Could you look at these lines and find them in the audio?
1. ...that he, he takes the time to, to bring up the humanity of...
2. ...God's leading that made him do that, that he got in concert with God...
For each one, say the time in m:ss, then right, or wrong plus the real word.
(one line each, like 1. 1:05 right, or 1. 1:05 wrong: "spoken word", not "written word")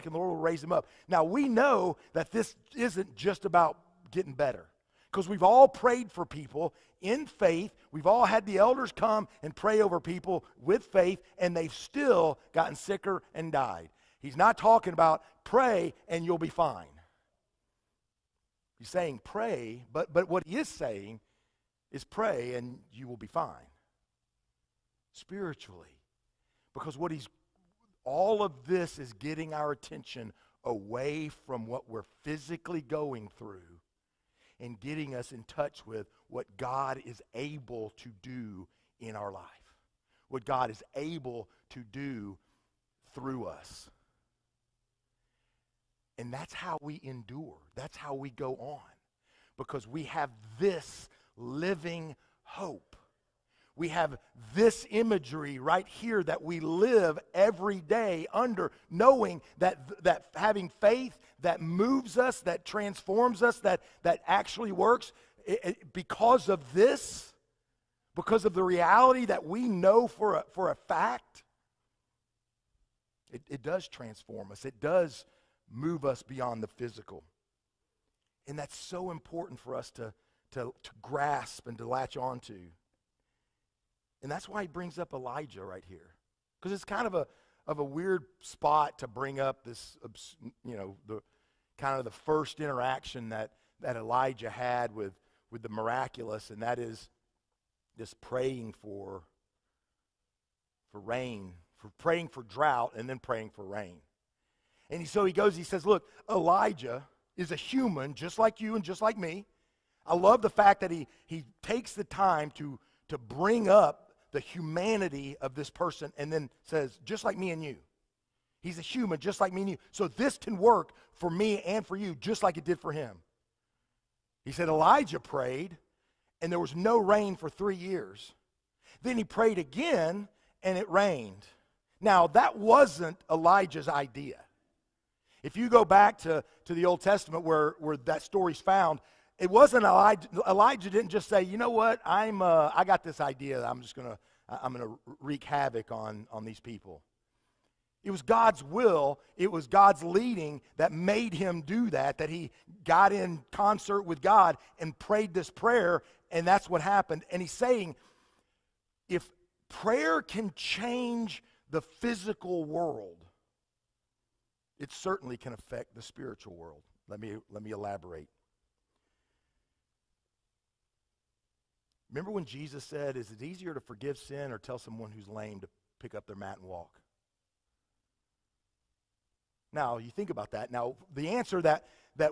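1. 1:50 right
2. 2:29 right.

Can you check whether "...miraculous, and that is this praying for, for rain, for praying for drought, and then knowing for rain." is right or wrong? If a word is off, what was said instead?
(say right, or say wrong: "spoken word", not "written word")
wrong: "praying", not "knowing".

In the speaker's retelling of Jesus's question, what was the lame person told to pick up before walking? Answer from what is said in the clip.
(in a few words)
Their mat.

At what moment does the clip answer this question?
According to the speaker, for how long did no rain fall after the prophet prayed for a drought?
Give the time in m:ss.
2:07.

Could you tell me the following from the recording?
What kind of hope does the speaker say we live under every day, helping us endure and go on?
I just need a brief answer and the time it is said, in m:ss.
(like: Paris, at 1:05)
Living hope, at 0:51.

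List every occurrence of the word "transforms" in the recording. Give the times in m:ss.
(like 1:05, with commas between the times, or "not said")
1:02, 1:13.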